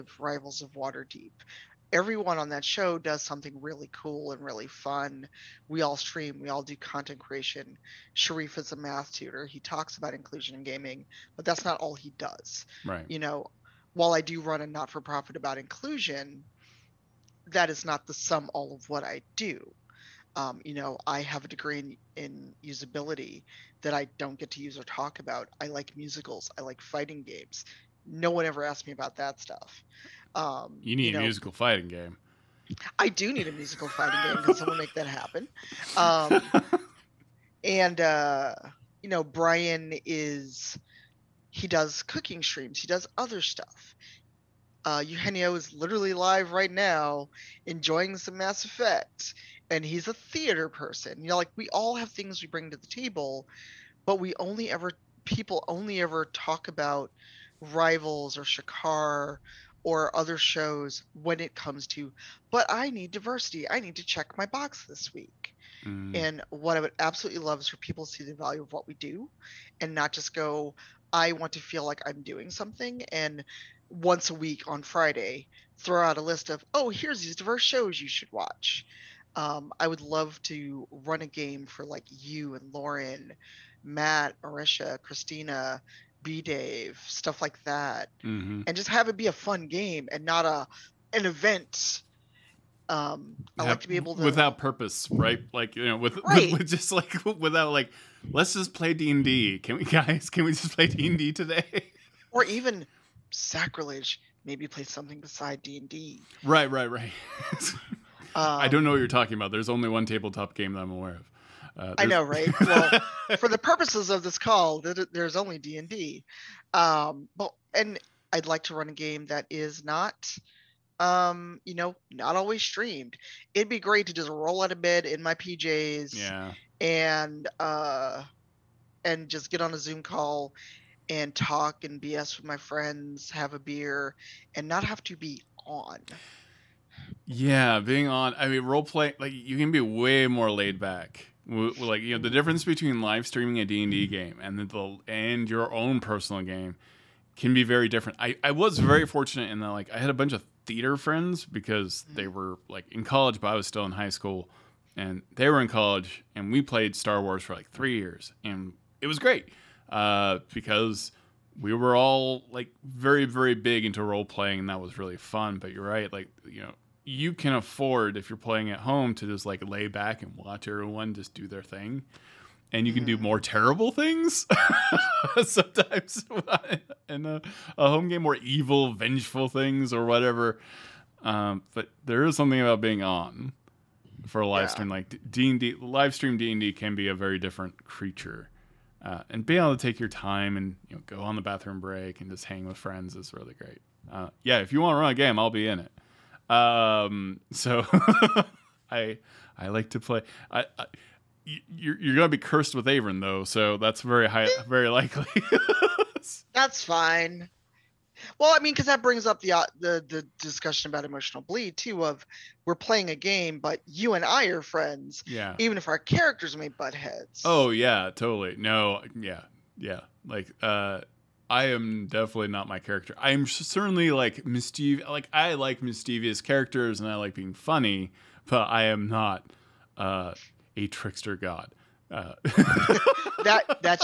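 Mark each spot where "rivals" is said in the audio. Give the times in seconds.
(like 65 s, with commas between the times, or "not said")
0 s, 57 s.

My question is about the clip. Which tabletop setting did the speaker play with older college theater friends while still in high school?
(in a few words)
Star Wars.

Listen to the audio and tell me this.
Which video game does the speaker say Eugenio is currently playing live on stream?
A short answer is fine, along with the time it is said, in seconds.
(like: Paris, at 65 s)
Mass Effect, at 48 s.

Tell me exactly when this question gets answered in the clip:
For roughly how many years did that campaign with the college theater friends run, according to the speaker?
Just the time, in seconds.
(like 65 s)
157 s.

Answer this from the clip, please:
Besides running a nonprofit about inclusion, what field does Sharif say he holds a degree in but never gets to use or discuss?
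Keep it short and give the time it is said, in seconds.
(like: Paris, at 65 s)
Usability, at 22 s.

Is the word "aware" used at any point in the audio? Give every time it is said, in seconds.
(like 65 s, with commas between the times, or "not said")
110 s.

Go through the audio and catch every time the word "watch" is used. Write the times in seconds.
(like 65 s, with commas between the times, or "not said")
78 s, 170 s.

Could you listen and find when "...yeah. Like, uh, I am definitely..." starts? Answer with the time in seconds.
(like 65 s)
219 s.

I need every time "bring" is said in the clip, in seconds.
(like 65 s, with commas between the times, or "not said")
52 s, 209 s.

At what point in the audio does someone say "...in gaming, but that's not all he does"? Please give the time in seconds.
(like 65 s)
10 s.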